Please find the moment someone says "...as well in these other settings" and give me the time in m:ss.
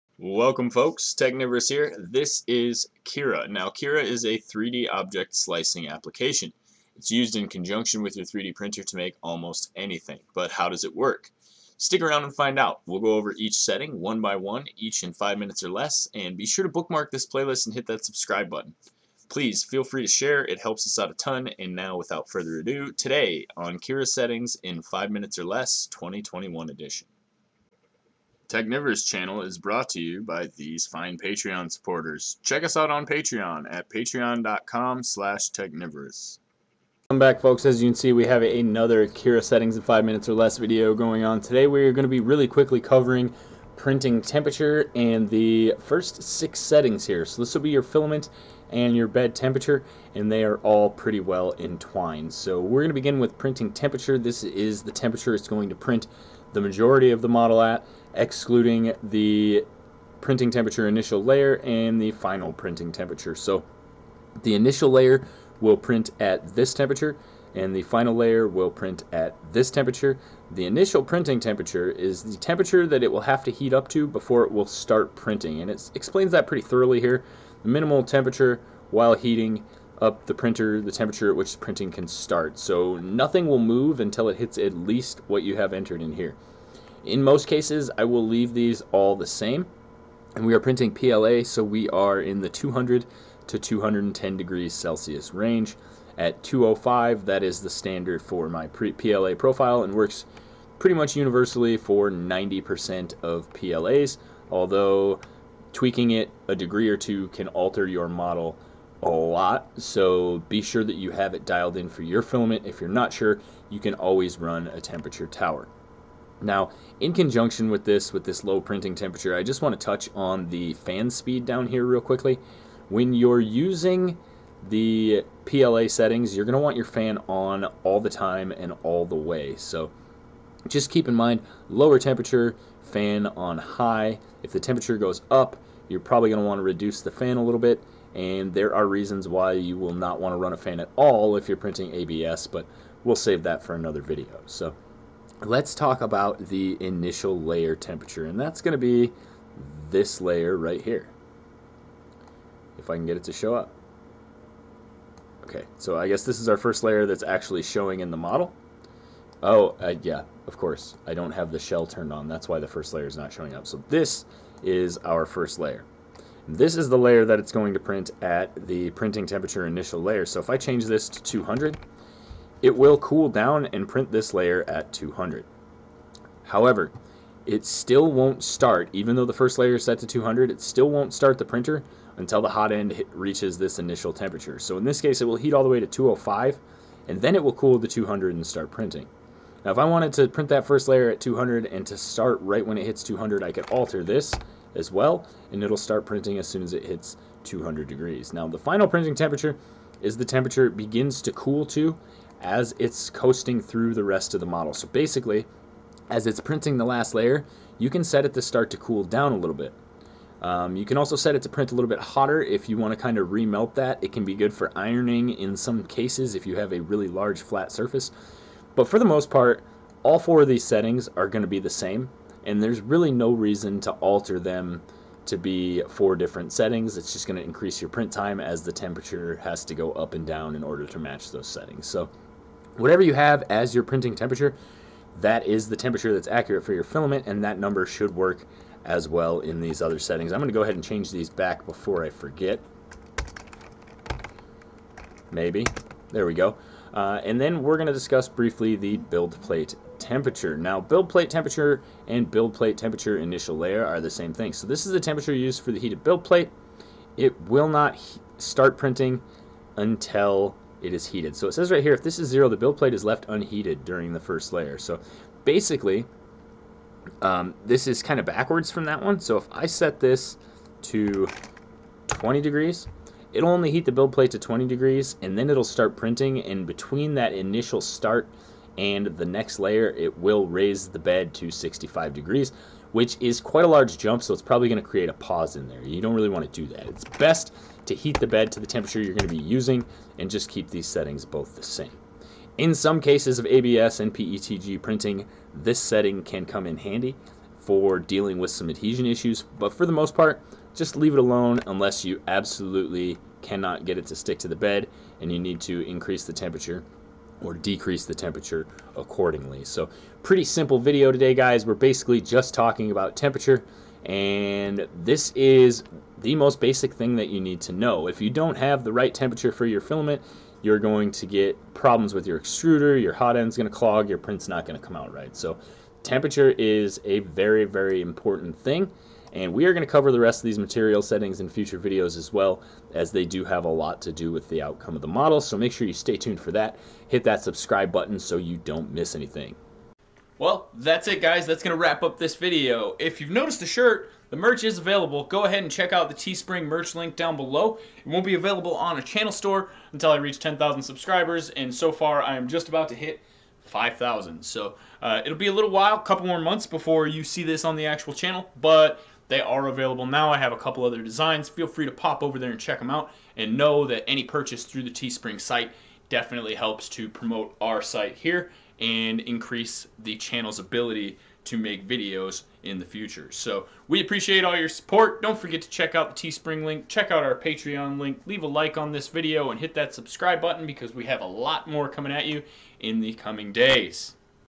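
3:58.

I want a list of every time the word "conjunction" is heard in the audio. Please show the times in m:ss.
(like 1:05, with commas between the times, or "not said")
0:07, 1:57.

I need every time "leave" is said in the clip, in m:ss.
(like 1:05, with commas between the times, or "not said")
1:28, 5:00, 6:18.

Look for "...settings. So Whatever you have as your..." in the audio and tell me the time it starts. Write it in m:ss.
3:51.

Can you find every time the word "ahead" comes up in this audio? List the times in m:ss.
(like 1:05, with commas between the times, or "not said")
4:00, 5:45.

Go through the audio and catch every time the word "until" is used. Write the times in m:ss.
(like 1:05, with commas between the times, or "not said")
1:23, 3:02, 4:19, 5:49.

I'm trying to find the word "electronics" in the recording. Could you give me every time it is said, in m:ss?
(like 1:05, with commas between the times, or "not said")
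not said.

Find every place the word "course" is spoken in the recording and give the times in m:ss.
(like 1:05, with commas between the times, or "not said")
2:40.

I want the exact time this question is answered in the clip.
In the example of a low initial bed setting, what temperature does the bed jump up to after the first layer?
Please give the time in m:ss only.
4:41.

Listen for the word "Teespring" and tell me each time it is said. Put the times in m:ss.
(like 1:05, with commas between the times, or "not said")
5:46, 6:04, 6:16.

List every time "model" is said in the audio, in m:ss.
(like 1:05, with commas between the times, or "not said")
0:57, 1:48, 2:38, 3:24, 5:35.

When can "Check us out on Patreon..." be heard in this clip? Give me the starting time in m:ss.
0:32.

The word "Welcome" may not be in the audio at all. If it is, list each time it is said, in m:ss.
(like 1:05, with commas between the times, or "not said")
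0:00, 0:37.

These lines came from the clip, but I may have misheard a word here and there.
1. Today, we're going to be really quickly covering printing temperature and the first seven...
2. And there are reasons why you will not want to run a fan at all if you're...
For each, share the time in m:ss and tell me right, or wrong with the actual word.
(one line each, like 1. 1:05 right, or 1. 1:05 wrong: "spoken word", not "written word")
1. 0:41 wrong: "six", not "seven"
2. 2:18 right.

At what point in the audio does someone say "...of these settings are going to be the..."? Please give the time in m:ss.
3:40.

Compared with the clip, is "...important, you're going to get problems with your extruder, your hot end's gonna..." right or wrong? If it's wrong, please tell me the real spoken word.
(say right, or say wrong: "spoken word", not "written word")
wrong: "filament", not "important".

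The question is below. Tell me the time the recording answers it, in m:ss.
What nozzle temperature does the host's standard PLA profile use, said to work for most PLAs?
1:36.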